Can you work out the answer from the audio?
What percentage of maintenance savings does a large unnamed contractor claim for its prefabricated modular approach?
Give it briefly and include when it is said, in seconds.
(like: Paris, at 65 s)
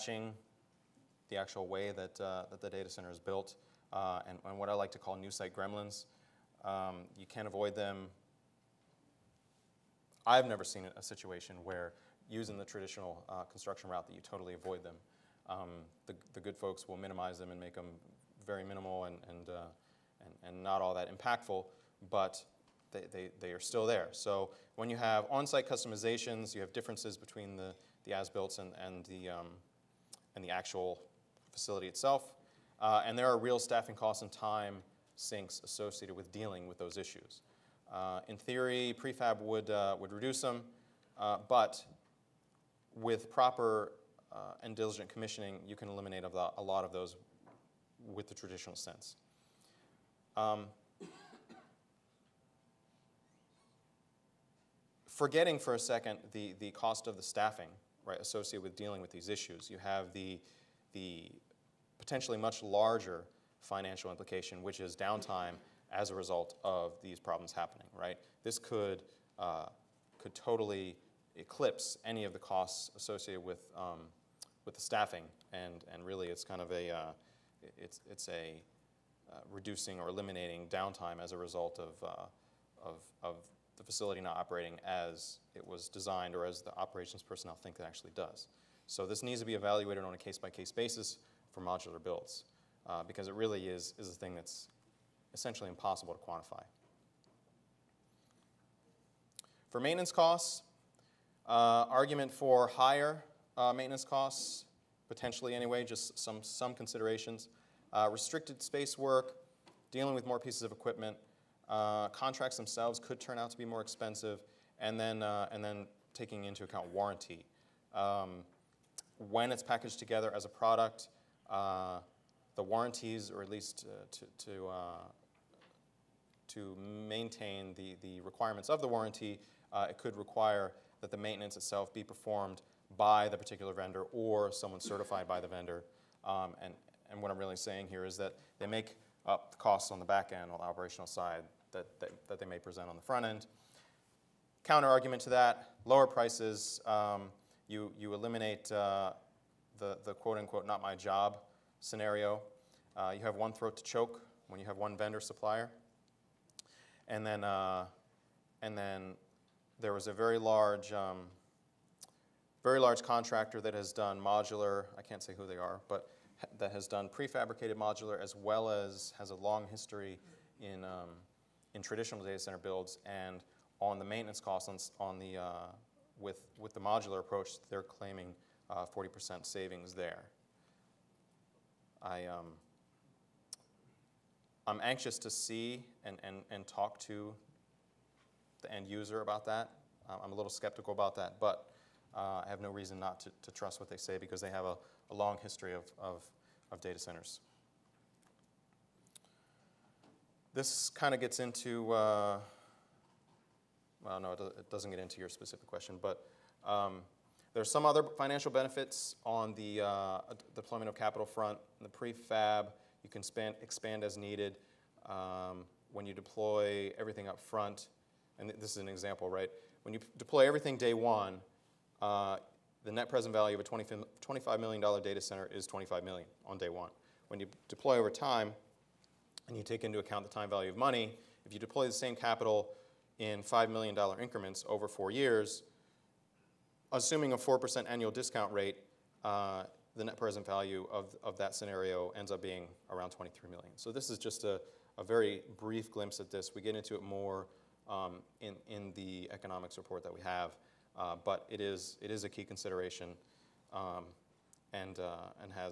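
40%, at 178 s.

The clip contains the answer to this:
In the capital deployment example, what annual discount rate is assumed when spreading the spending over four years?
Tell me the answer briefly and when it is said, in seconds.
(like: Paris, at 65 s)
4%, at 237 s.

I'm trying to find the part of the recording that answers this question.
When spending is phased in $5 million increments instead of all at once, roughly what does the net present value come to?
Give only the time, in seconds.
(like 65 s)
242 s.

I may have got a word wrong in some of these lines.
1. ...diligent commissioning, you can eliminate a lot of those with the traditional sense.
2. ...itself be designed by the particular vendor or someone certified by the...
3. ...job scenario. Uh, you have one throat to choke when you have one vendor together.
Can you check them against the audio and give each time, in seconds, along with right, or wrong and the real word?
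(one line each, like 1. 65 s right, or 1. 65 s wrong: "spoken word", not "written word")
1. 44 s right
2. 131 s wrong: "performed", not "designed"
3. 150 s wrong: "supplier", not "together".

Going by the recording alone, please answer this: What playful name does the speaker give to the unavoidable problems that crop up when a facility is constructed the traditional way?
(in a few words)
new site gremlins.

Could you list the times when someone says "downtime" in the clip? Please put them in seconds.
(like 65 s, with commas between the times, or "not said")
64 s, 80 s.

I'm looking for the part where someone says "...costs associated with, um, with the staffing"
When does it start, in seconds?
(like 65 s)
72 s.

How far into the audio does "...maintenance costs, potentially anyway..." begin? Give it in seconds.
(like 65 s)
103 s.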